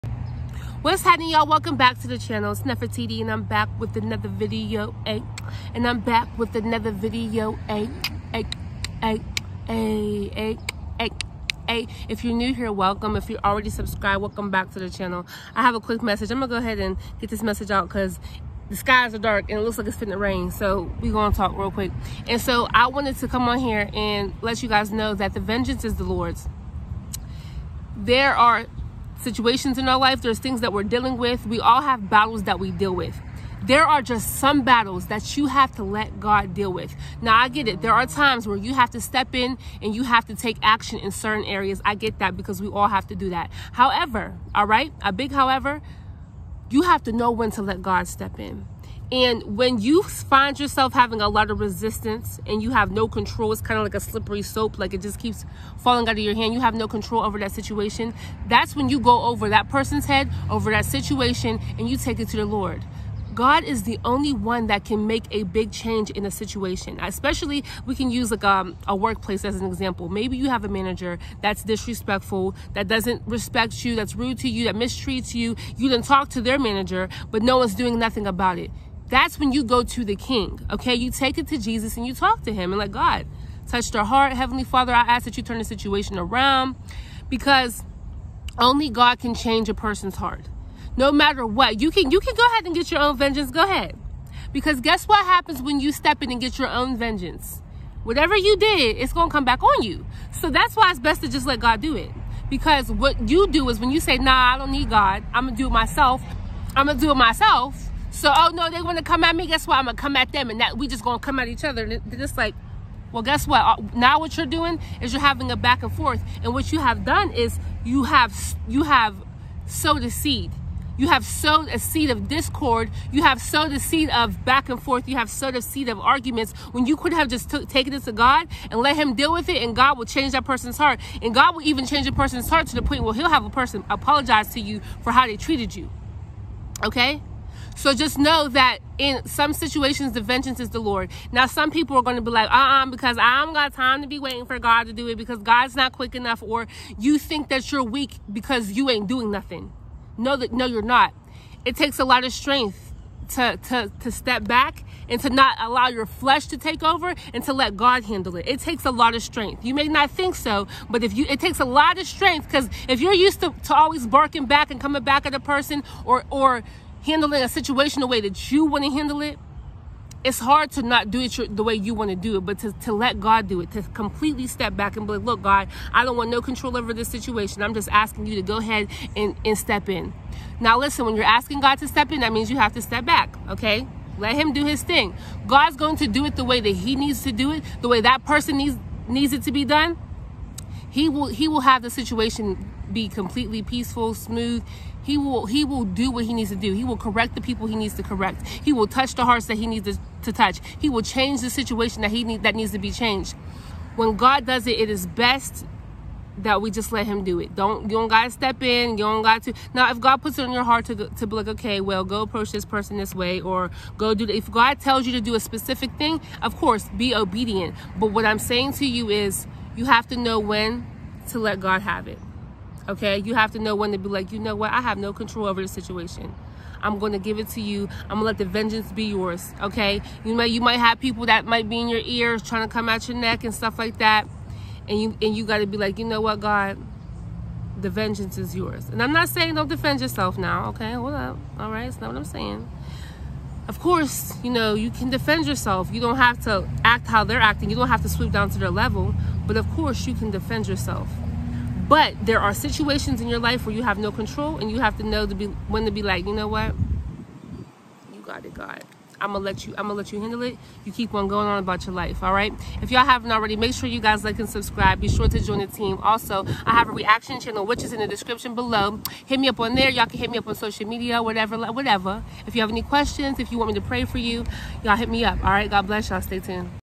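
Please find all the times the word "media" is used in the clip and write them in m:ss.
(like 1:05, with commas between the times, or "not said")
4:30.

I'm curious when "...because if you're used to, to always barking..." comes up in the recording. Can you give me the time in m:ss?
2:42.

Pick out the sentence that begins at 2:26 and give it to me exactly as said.
Or you think that you're weak because you ain't doing nothing.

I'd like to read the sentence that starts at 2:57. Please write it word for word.
I'm just asking you to go ahead and, and step in.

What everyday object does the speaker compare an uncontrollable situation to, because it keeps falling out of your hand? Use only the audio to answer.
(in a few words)
Slippery soap.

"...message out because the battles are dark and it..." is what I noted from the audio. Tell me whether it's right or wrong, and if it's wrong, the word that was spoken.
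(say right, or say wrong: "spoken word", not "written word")
wrong: "skies", not "battles".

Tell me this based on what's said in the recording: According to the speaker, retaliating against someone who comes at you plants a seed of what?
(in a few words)
Discord.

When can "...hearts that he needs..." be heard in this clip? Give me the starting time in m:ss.
3:19.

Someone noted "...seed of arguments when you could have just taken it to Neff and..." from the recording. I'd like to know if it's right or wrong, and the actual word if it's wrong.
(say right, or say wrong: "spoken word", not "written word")
wrong: "God", not "Neff".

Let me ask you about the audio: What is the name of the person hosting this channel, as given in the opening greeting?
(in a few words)
Neff Taylor.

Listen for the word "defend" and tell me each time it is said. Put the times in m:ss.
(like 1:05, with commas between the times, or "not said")
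3:59, 4:05, 4:10.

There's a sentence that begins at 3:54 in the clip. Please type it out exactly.
And you and you got to be like, "You know what, God?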